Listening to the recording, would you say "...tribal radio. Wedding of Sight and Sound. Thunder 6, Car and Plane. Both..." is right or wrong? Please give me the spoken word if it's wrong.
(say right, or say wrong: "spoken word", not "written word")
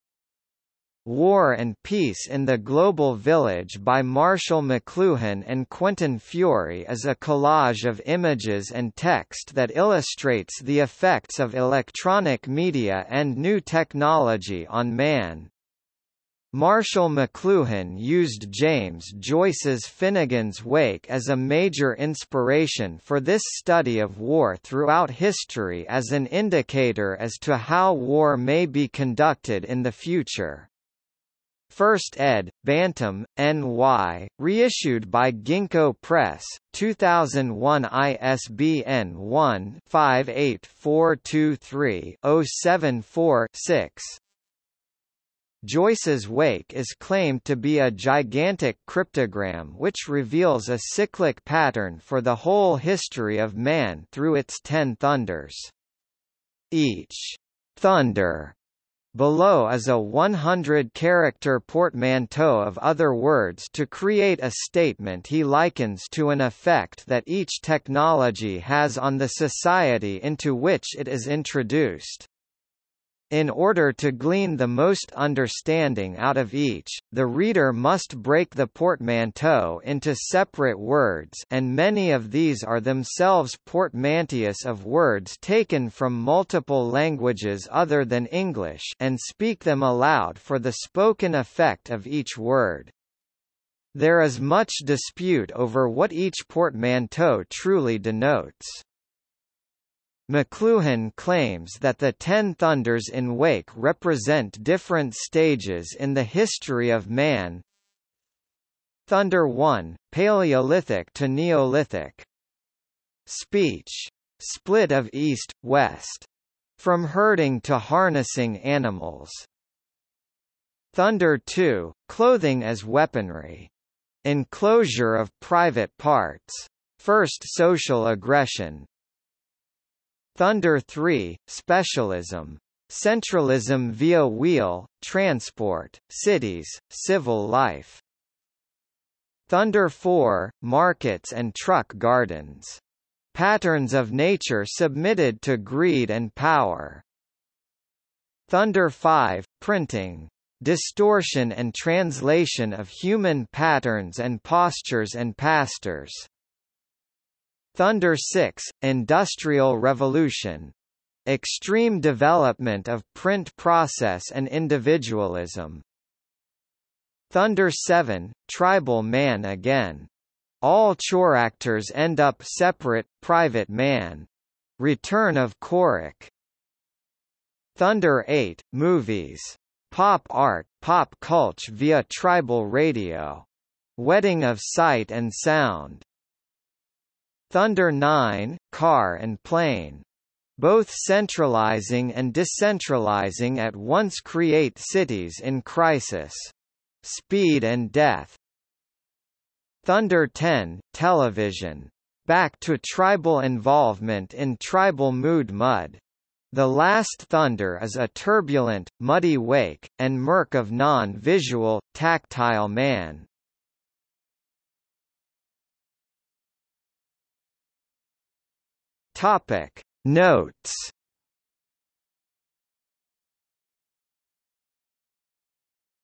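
wrong: "9", not "6".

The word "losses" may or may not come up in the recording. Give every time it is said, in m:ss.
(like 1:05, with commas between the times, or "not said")
not said.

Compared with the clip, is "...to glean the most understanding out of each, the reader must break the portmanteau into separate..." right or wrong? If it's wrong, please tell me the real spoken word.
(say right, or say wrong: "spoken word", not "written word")
right.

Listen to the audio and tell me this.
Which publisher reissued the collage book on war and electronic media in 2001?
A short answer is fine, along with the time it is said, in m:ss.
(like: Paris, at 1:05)
Ginkgo Press, at 0:35.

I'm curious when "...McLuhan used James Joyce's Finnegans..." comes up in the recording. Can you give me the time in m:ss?
0:17.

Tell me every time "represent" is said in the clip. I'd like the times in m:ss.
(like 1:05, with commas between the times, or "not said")
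1:43.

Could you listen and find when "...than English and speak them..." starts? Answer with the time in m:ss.
1:28.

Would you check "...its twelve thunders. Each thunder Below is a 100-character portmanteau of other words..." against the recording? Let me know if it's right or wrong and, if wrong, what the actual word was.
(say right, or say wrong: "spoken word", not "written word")
wrong: "ten", not "twelve".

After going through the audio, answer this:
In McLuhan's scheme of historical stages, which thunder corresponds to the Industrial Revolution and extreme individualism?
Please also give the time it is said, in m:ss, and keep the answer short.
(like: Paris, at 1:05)
Thunder 6, at 2:37.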